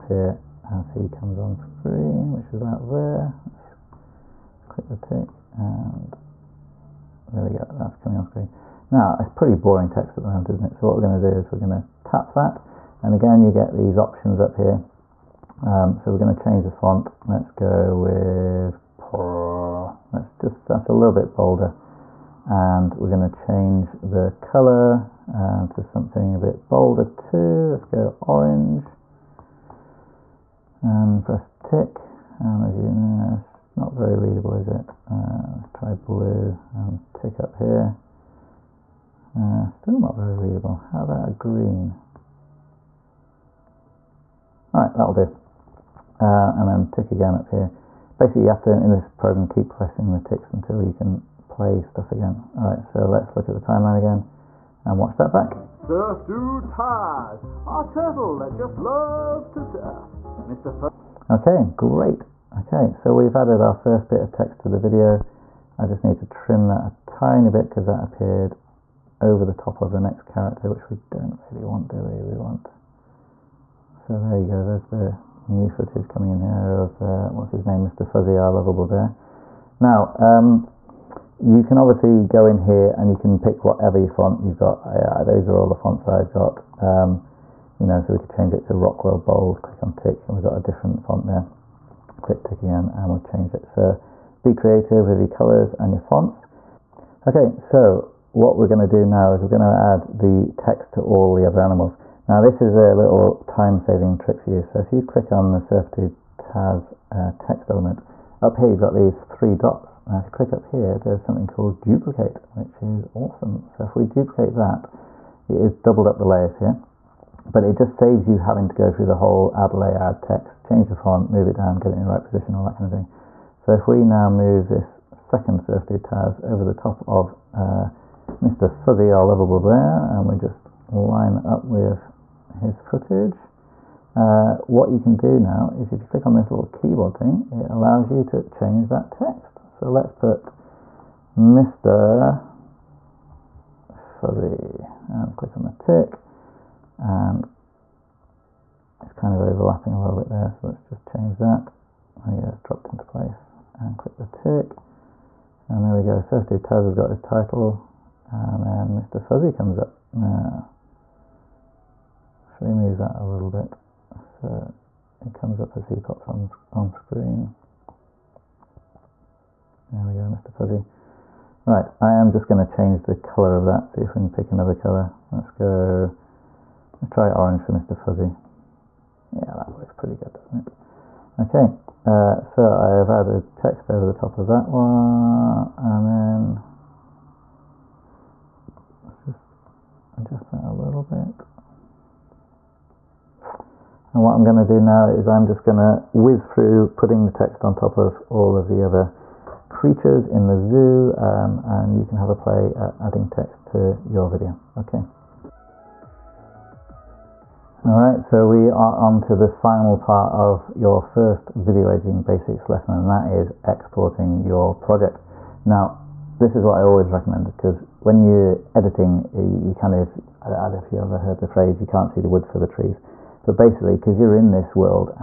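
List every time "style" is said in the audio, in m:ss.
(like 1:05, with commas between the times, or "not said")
not said.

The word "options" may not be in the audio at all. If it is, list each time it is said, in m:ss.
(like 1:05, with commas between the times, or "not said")
0:13.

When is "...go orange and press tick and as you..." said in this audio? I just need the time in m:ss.
0:27.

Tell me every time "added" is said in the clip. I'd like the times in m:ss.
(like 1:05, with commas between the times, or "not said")
1:03, 3:03.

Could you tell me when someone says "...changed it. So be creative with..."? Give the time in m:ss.
1:33.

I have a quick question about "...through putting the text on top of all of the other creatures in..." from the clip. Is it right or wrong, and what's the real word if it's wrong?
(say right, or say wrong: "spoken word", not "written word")
right.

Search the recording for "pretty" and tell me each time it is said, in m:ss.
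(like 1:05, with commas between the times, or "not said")
0:09, 2:59.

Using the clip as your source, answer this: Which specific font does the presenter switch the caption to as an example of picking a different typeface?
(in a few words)
Rockwell Bold.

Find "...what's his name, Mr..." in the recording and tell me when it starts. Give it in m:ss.
1:17.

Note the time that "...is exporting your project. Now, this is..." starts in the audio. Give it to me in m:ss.
3:33.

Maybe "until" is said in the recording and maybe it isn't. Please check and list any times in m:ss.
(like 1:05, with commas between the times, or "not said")
0:50.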